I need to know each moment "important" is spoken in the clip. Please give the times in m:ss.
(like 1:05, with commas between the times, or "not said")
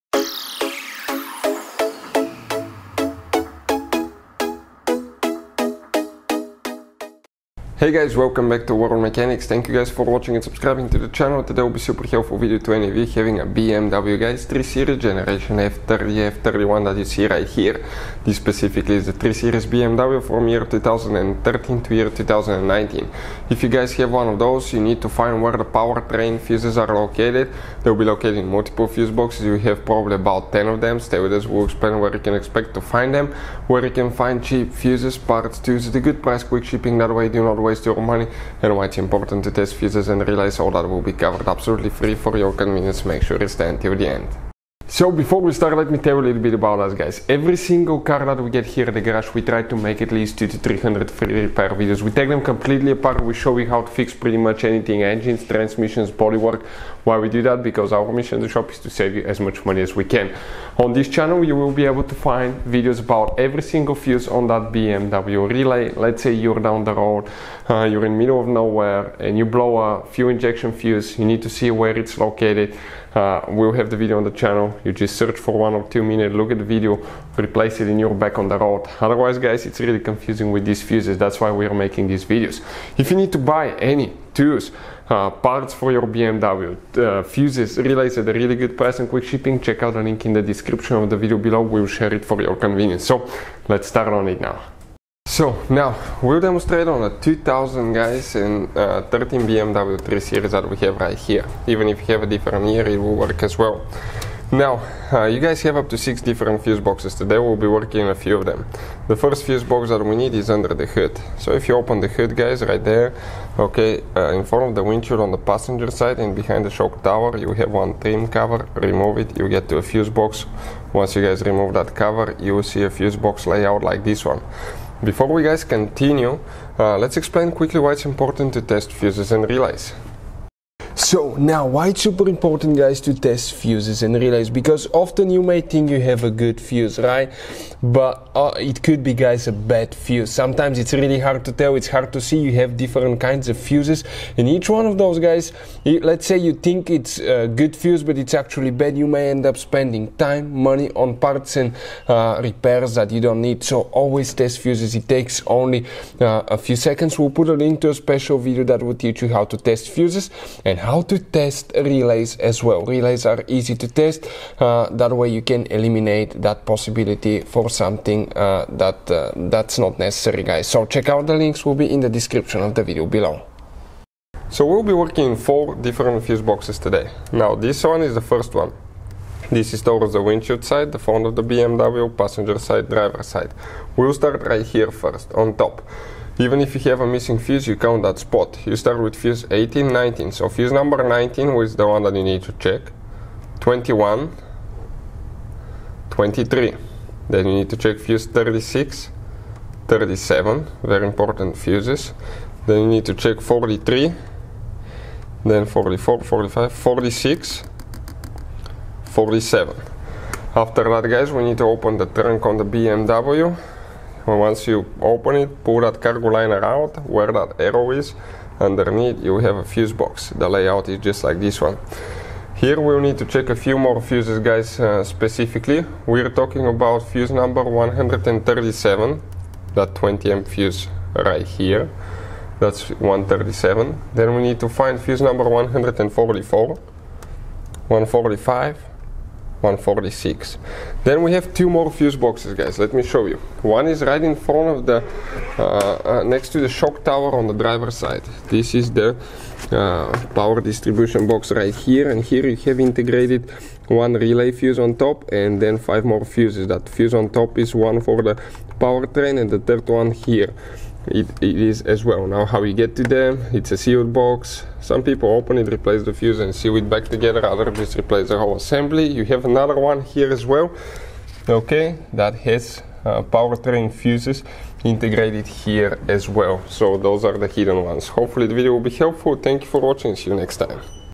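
0:38, 2:08, 2:12, 3:21.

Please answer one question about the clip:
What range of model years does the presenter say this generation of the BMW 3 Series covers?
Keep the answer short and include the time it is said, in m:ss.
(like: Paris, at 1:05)
2013 to 2019, at 0:20.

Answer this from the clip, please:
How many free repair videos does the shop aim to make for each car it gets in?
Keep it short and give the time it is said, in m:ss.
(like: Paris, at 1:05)
2 to 300, at 0:50.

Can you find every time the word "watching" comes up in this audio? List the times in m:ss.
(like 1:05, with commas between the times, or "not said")
0:10, 4:39.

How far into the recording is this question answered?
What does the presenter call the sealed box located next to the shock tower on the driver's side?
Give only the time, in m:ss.
4:10.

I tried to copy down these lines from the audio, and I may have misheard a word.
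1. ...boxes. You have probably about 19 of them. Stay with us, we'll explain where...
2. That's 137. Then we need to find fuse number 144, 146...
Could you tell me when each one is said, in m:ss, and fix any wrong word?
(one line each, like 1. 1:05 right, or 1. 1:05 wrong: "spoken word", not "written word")
1. 0:29 wrong: "10", not "19"
2. 3:52 wrong: "145", not "146".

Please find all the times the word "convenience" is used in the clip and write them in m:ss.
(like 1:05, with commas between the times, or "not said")
0:42, 1:32.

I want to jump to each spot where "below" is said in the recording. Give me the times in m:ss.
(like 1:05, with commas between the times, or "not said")
1:31, 2:53.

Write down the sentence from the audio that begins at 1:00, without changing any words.
On this channel, you will be able to find videos about every single fuse on that BMW relay.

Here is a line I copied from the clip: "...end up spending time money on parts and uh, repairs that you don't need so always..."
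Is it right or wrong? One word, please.
right.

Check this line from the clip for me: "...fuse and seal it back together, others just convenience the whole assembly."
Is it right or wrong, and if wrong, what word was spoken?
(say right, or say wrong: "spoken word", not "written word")
wrong: "replace", not "convenience".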